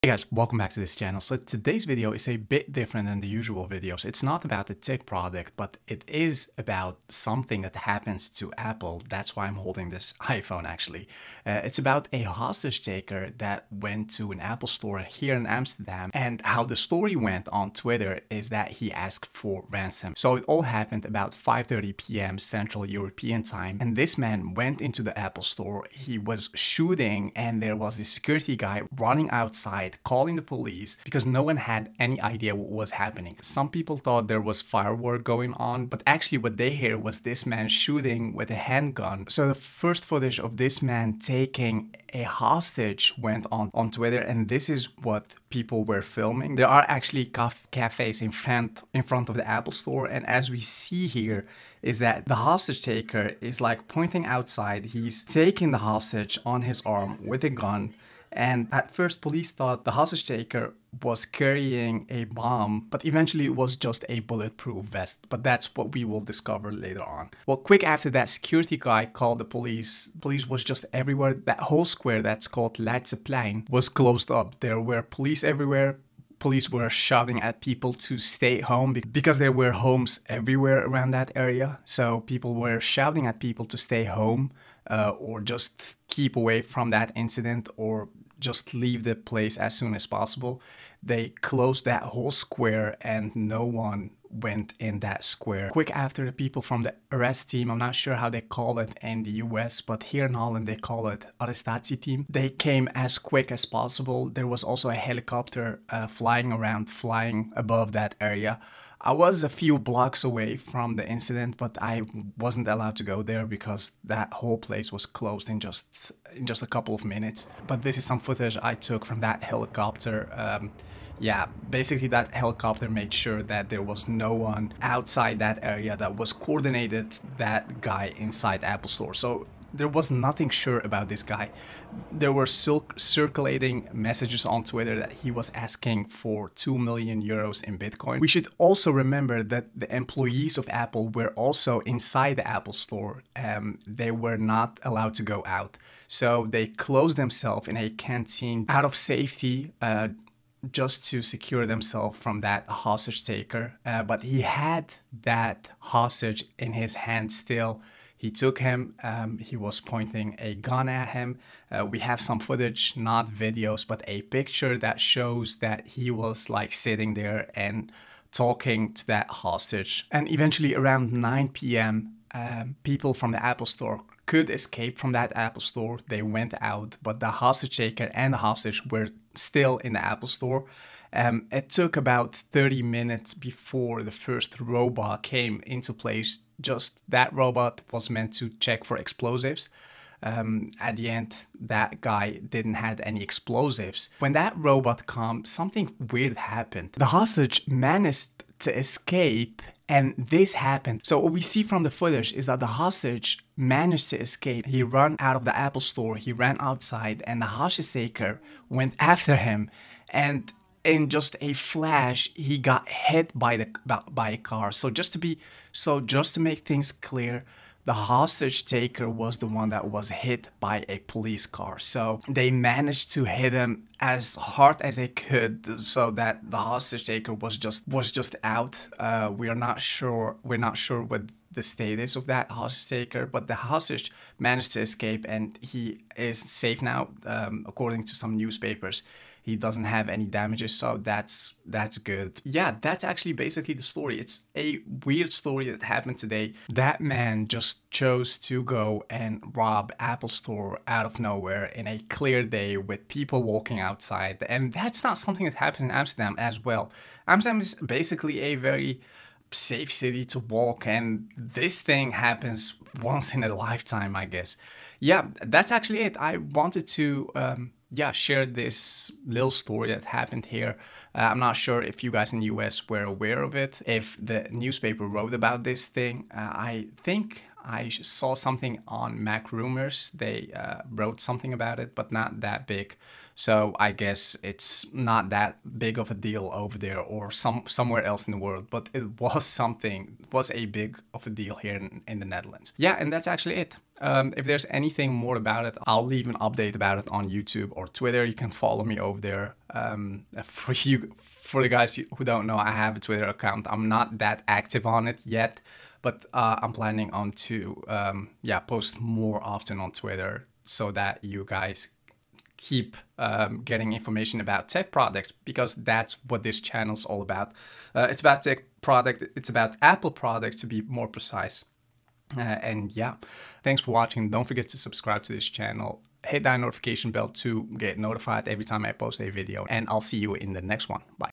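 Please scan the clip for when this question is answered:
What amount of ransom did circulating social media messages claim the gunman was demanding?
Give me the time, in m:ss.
2:16.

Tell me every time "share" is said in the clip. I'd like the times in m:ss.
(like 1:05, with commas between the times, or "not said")
4:28.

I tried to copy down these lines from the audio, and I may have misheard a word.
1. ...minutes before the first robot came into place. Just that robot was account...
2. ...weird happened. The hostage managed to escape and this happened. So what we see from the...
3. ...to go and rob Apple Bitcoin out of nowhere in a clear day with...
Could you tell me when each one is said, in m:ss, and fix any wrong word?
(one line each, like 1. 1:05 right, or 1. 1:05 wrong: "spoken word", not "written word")
1. 3:02 wrong: "meant", not "account"
2. 3:16 right
3. 4:08 wrong: "Store", not "Bitcoin".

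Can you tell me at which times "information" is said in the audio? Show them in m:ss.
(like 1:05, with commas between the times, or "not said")
5:13.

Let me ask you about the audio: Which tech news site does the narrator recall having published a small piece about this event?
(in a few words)
Mac Rumors.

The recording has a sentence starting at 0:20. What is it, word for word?
So it all happened about 5.30 p.m.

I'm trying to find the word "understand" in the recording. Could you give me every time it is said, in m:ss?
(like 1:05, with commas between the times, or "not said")
not said.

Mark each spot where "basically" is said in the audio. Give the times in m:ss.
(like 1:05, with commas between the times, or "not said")
2:01, 4:03, 4:17.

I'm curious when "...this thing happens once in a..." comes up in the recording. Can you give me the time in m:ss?
4:21.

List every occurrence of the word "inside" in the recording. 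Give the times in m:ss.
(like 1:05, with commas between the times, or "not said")
2:08, 2:21.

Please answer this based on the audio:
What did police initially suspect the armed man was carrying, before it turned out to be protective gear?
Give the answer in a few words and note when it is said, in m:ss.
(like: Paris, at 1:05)
A bomb, at 1:02.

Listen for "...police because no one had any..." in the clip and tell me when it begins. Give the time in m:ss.
0:30.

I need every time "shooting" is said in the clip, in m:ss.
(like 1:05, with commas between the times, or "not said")
0:26, 0:37.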